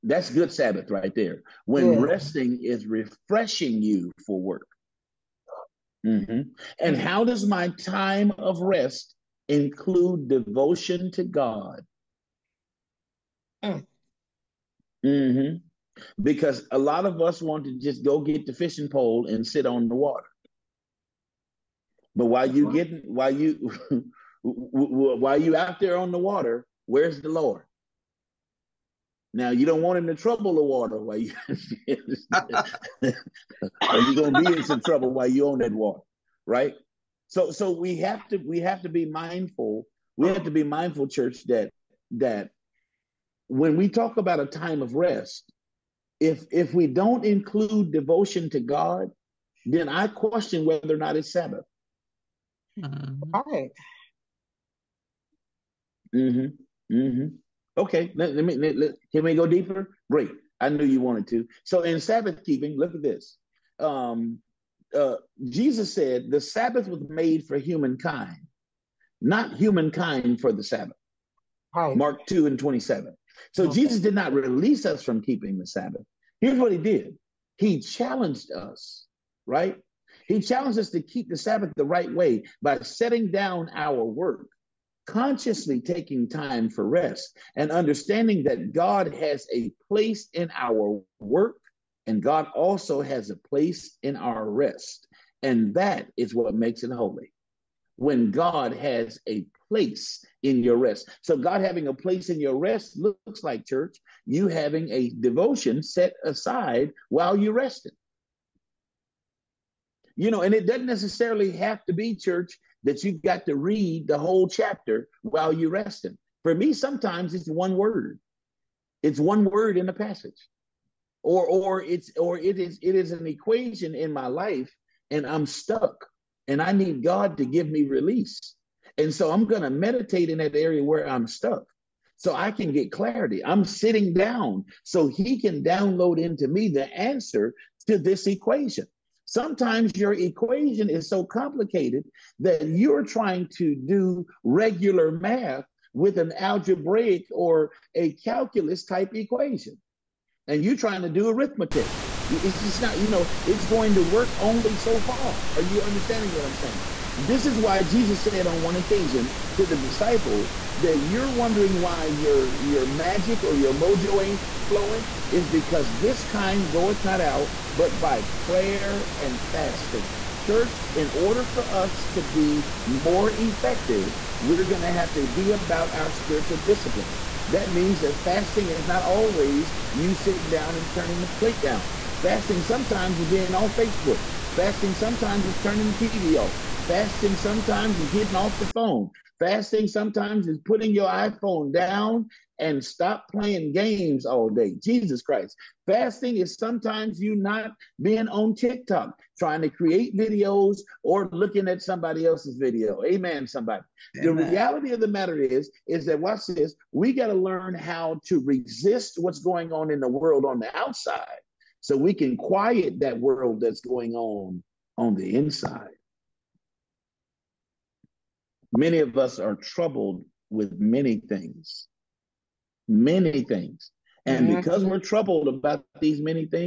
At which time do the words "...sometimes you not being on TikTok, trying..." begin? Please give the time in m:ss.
3:16.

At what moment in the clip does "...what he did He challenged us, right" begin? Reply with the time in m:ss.
1:16.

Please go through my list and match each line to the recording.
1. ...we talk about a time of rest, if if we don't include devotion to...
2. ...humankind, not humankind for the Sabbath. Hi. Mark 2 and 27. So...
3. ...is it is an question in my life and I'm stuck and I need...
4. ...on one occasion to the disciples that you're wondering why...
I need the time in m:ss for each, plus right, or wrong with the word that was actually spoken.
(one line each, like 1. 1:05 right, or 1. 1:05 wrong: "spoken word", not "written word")
1. 0:43 right
2. 1:07 right
3. 2:02 wrong: "equation", not "question"
4. 2:38 right.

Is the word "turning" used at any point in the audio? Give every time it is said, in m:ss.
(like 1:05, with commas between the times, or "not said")
3:00, 3:05.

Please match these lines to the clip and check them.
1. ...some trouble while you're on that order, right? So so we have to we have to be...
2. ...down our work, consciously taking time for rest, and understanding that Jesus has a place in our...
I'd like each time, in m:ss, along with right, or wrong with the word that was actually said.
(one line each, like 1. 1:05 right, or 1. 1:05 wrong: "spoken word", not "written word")
1. 0:34 wrong: "water", not "order"
2. 1:23 wrong: "God", not "Jesus".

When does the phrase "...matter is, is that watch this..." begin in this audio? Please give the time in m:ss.
3:25.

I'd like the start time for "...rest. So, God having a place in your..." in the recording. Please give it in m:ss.
1:40.